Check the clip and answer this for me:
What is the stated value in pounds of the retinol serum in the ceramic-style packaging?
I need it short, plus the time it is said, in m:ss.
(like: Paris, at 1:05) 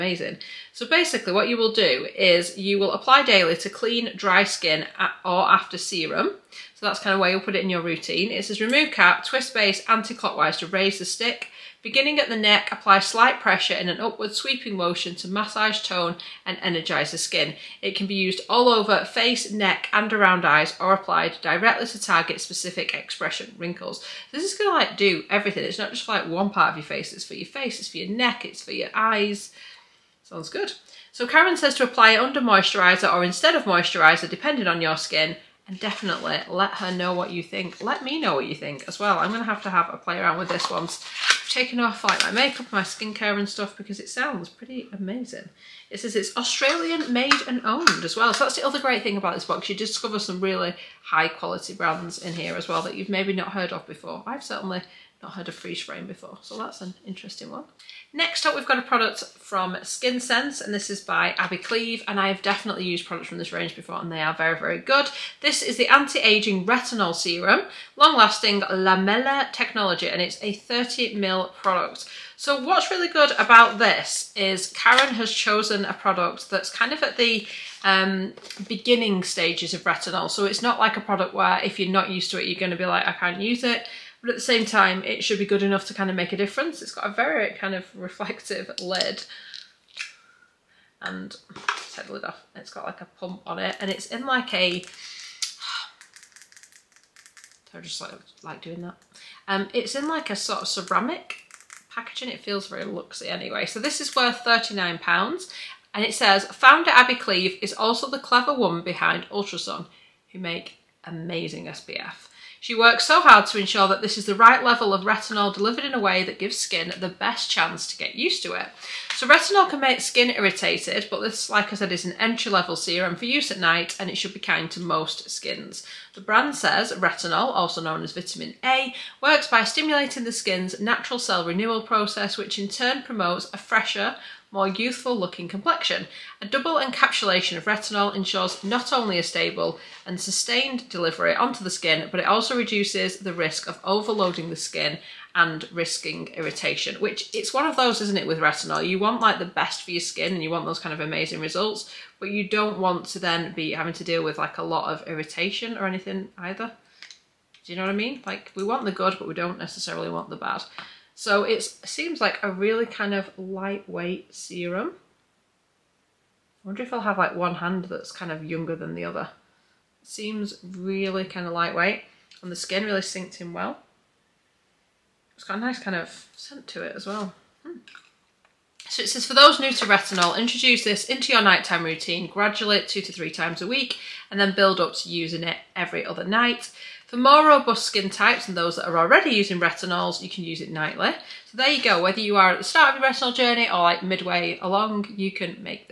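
£39, at 1:44.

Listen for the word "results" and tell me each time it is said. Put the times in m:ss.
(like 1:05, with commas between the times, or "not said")
2:31.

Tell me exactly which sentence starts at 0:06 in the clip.
So that's kind of where you'll put it in your routine.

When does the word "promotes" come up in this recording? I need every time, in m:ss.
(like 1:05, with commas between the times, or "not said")
2:13.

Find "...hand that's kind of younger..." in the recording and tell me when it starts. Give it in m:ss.
2:47.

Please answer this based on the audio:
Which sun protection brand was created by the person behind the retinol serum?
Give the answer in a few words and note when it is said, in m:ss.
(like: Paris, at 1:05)
Ultrasun, at 1:49.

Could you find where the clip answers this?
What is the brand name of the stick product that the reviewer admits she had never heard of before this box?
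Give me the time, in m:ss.
0:55.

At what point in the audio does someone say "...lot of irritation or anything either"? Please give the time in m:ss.
2:34.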